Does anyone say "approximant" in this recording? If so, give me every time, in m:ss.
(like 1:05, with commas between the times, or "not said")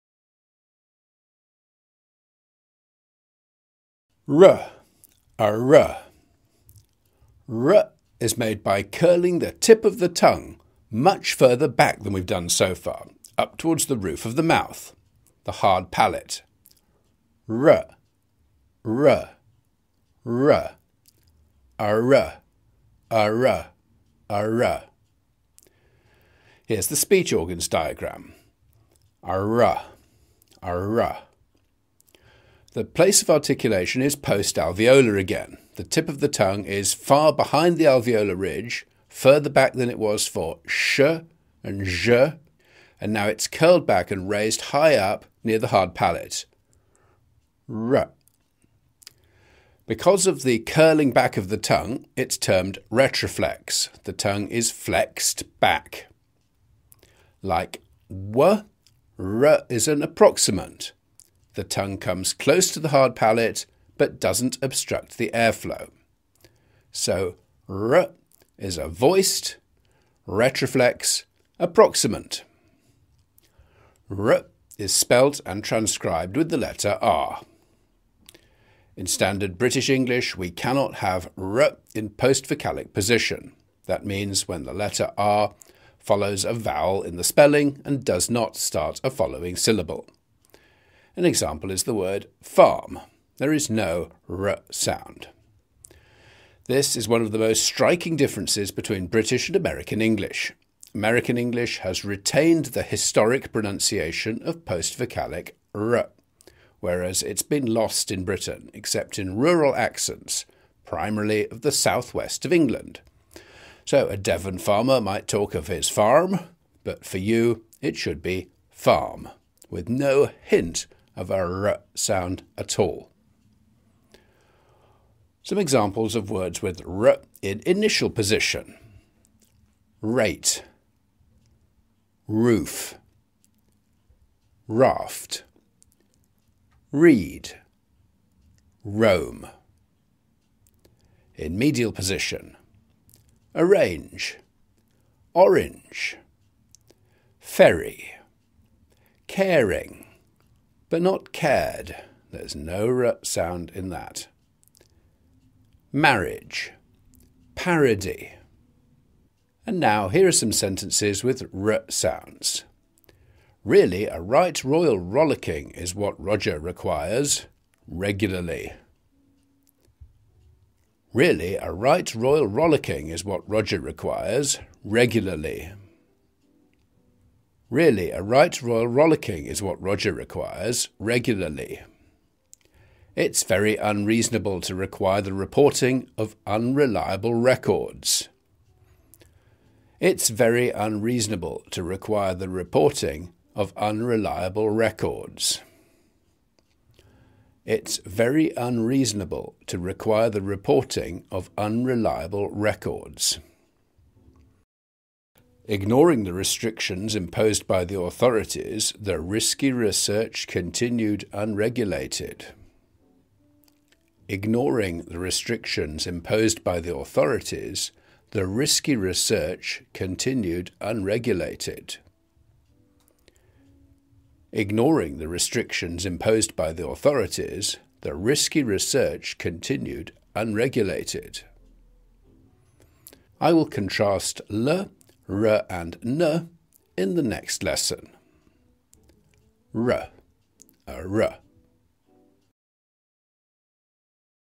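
1:00, 1:11.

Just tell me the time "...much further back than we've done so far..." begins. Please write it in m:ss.
0:10.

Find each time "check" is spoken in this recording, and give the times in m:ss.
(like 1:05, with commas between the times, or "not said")
not said.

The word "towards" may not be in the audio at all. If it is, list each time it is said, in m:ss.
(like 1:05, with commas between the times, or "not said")
0:13.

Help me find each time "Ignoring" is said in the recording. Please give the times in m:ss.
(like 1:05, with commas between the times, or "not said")
3:25, 3:34, 3:44.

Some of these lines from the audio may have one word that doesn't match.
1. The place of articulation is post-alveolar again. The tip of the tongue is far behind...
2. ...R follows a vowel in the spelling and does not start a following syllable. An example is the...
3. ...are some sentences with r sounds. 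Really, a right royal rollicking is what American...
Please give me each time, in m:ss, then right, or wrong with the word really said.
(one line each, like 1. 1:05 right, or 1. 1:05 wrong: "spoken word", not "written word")
1. 0:32 right
2. 1:25 right
3. 2:40 wrong: "Roger", not "American".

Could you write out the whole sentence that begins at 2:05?
Some examples of words with r in initial position.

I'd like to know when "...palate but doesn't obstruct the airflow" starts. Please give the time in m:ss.
1:03.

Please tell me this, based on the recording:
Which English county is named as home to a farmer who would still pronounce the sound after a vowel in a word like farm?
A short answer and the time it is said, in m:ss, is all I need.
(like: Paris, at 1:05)
Devon, at 1:53.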